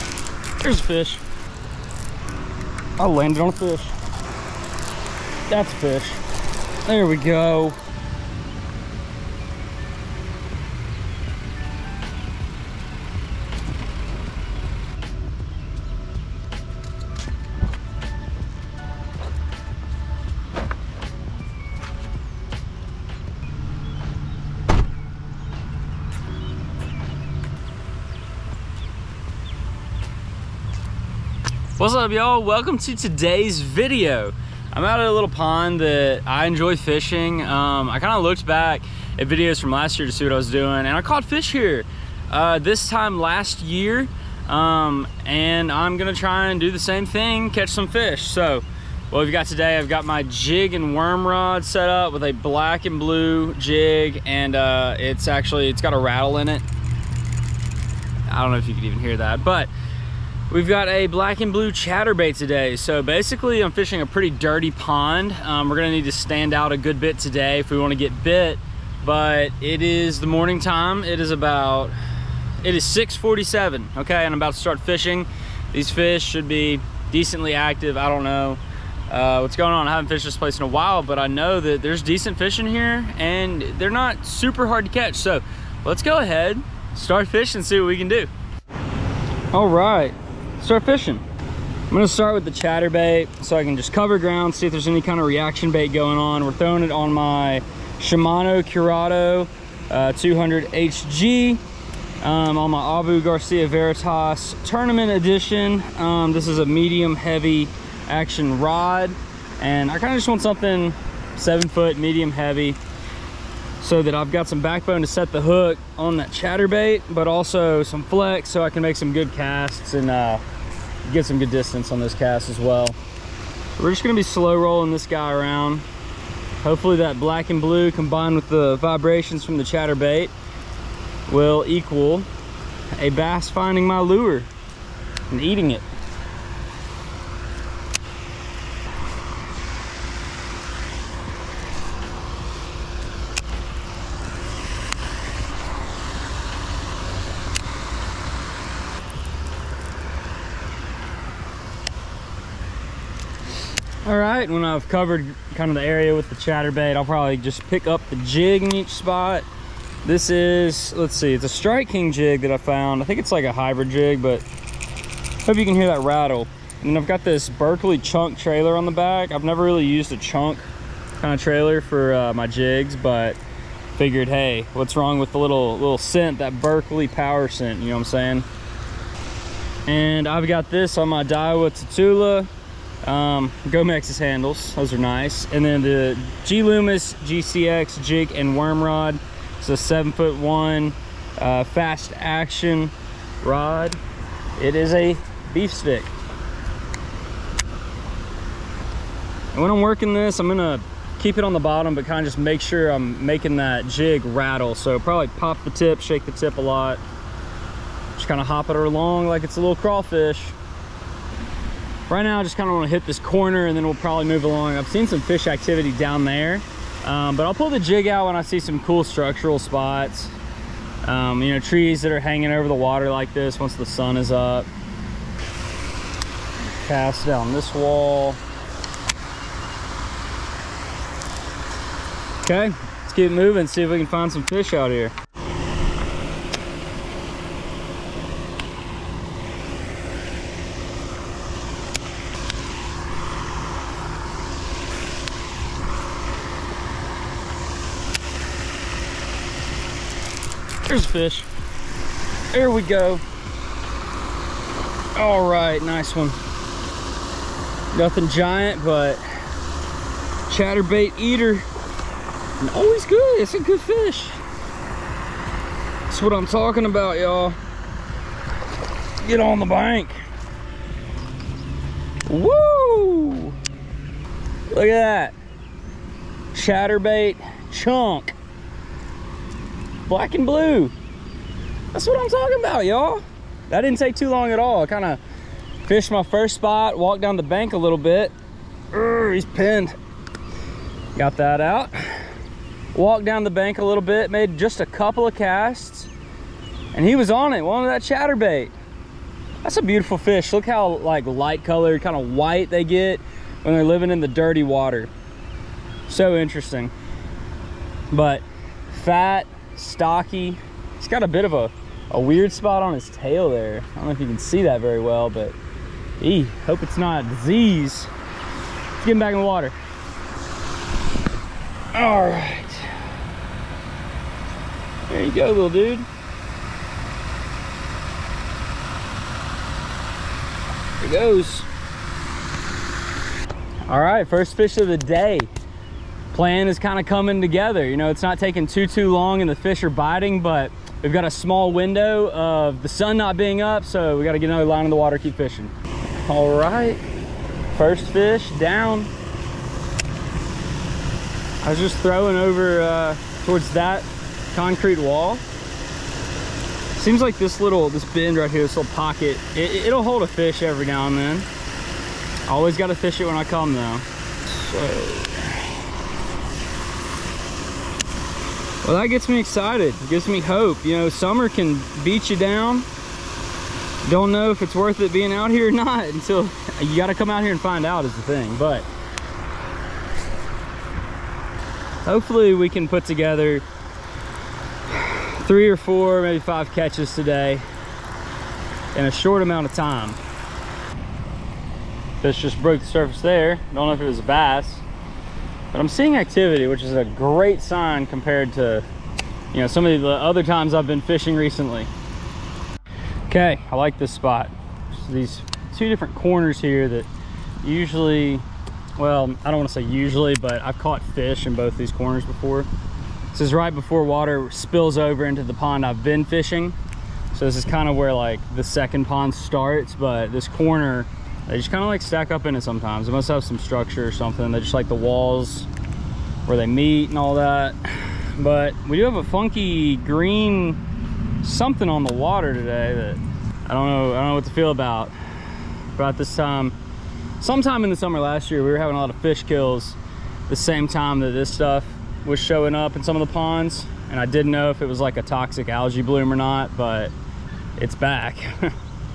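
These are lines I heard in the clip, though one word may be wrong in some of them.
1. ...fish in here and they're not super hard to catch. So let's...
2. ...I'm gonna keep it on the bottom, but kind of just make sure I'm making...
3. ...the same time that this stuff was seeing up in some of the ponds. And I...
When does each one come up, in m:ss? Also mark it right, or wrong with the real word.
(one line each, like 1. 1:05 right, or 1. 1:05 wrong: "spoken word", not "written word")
1. 1:22 right
2. 3:20 right
3. 7:20 wrong: "showing", not "seeing".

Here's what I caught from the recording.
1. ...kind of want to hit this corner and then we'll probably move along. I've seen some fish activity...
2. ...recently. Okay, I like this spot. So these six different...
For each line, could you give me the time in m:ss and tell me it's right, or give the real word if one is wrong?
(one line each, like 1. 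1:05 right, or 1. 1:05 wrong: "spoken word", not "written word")
1. 3:32 right
2. 6:41 wrong: "two", not "six".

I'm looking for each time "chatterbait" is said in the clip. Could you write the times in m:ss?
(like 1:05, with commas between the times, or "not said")
1:01, 1:32, 1:56, 2:09, 2:36, 4:20, 4:36, 4:58.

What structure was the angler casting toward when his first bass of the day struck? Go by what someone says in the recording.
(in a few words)
concrete wall.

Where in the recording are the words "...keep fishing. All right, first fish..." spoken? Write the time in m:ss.
5:45.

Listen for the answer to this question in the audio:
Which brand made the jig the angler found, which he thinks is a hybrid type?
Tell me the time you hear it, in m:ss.
2:41.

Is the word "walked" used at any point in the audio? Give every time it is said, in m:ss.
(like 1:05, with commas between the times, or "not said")
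4:46, 4:52.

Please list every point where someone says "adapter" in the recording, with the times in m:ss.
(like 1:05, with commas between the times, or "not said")
not said.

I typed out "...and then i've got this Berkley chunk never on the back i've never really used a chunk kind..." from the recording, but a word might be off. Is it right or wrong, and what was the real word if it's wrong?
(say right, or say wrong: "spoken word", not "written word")
wrong: "trailer", not "never".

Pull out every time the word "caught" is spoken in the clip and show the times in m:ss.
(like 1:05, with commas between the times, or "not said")
0:41, 6:50.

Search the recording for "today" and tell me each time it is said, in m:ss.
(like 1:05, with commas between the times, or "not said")
0:32, 0:49, 1:02, 1:07, 6:27, 7:12.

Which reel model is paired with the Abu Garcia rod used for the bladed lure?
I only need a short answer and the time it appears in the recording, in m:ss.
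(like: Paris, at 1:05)
Shimano Curado 200 HG, at 1:37.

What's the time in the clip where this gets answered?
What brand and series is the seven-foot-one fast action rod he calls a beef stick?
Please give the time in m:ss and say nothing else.
3:06.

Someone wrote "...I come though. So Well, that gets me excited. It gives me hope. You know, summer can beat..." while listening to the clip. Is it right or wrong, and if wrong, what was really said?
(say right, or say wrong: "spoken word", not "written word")
right.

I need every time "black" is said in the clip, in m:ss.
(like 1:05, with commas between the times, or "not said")
0:52, 1:01, 2:07, 4:40.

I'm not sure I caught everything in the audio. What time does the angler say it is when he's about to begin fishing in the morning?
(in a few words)
6:47.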